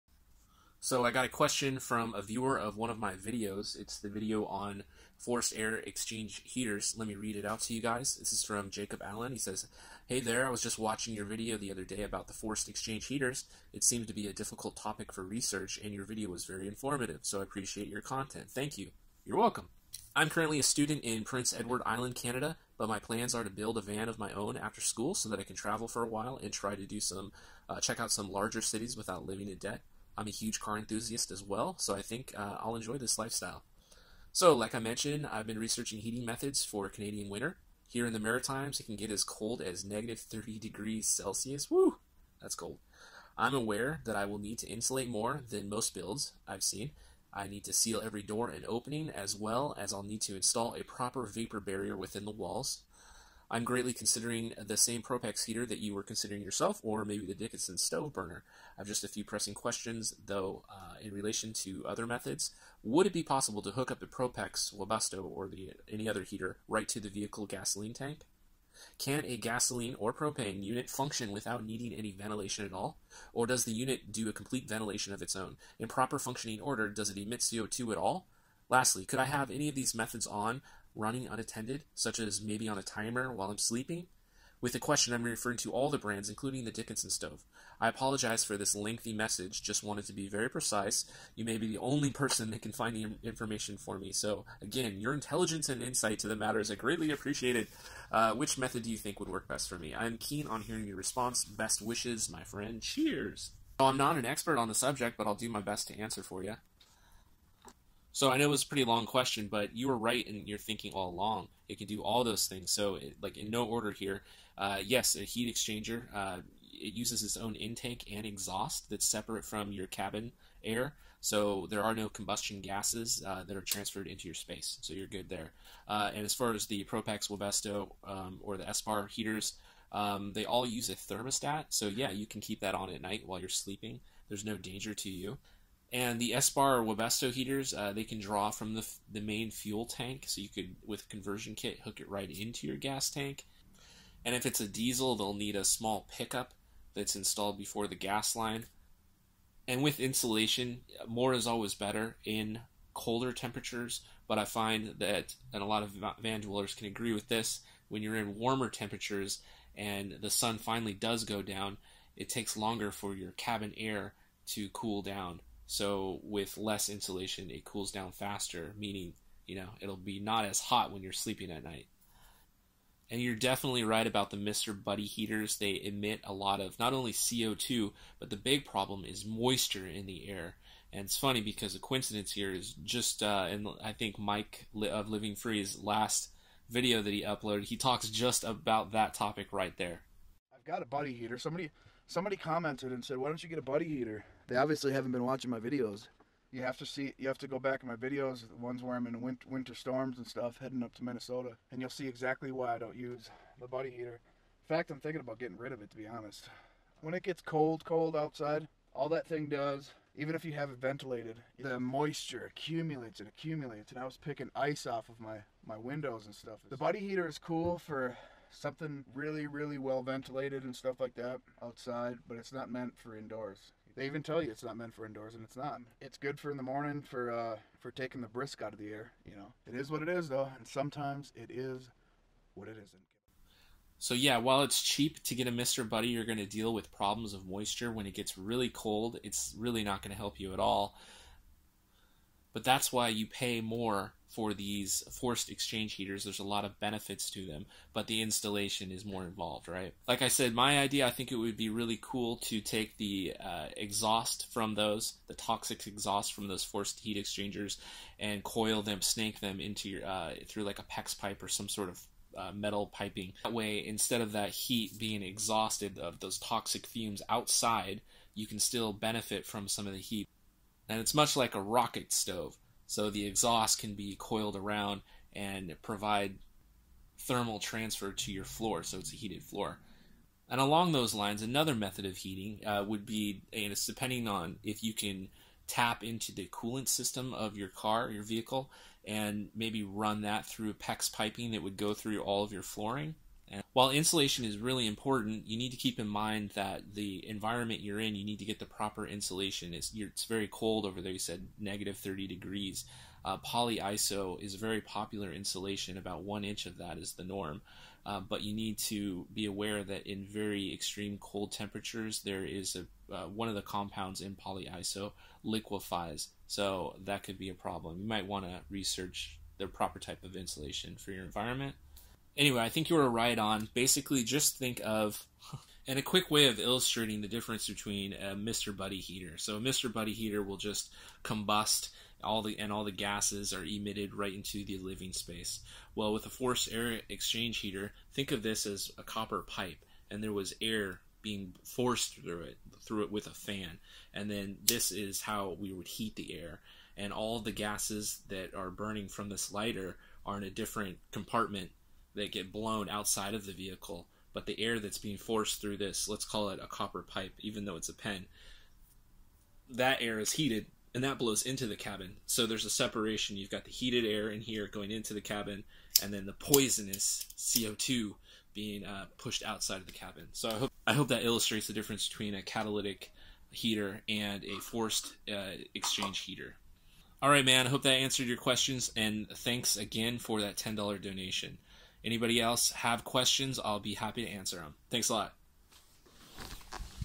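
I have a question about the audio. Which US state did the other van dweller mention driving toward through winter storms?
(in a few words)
Minnesota.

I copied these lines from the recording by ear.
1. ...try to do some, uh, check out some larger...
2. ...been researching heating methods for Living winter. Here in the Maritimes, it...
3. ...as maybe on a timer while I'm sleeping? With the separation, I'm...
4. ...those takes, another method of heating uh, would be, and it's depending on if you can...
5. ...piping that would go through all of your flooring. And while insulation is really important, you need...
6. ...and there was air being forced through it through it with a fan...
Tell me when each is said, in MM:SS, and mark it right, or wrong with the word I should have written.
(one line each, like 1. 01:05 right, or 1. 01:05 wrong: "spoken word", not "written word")
1. 00:26 right
2. 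00:35 wrong: "Canadian", not "Living"
3. 01:22 wrong: "question", not "separation"
4. 04:40 wrong: "lines", not "takes"
5. 04:51 right
6. 05:40 right.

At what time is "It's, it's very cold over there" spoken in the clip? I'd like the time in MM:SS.
04:59.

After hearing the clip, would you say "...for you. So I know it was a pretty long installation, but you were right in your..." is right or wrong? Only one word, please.
wrong.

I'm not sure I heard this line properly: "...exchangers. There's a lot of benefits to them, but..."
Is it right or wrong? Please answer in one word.
wrong.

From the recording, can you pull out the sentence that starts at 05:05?
About one inch of that is the norm.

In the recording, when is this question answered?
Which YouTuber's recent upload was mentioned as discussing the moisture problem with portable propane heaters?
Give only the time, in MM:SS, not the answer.
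03:04.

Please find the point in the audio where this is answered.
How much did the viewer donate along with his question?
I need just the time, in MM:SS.
06:20.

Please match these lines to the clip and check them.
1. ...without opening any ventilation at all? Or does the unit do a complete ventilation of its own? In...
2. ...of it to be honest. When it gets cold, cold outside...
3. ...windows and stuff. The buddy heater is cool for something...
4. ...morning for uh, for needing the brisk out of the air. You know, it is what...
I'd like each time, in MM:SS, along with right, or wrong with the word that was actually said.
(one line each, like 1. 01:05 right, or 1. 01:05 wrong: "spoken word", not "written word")
1. 01:11 wrong: "needing", not "opening"
2. 03:25 right
3. 03:35 right
4. 03:46 wrong: "taking", not "needing".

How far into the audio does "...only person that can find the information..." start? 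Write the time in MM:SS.
01:31.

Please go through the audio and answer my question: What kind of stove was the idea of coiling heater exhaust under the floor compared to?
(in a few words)
rocket stove.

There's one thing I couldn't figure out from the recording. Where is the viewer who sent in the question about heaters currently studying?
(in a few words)
Prince Edward Island.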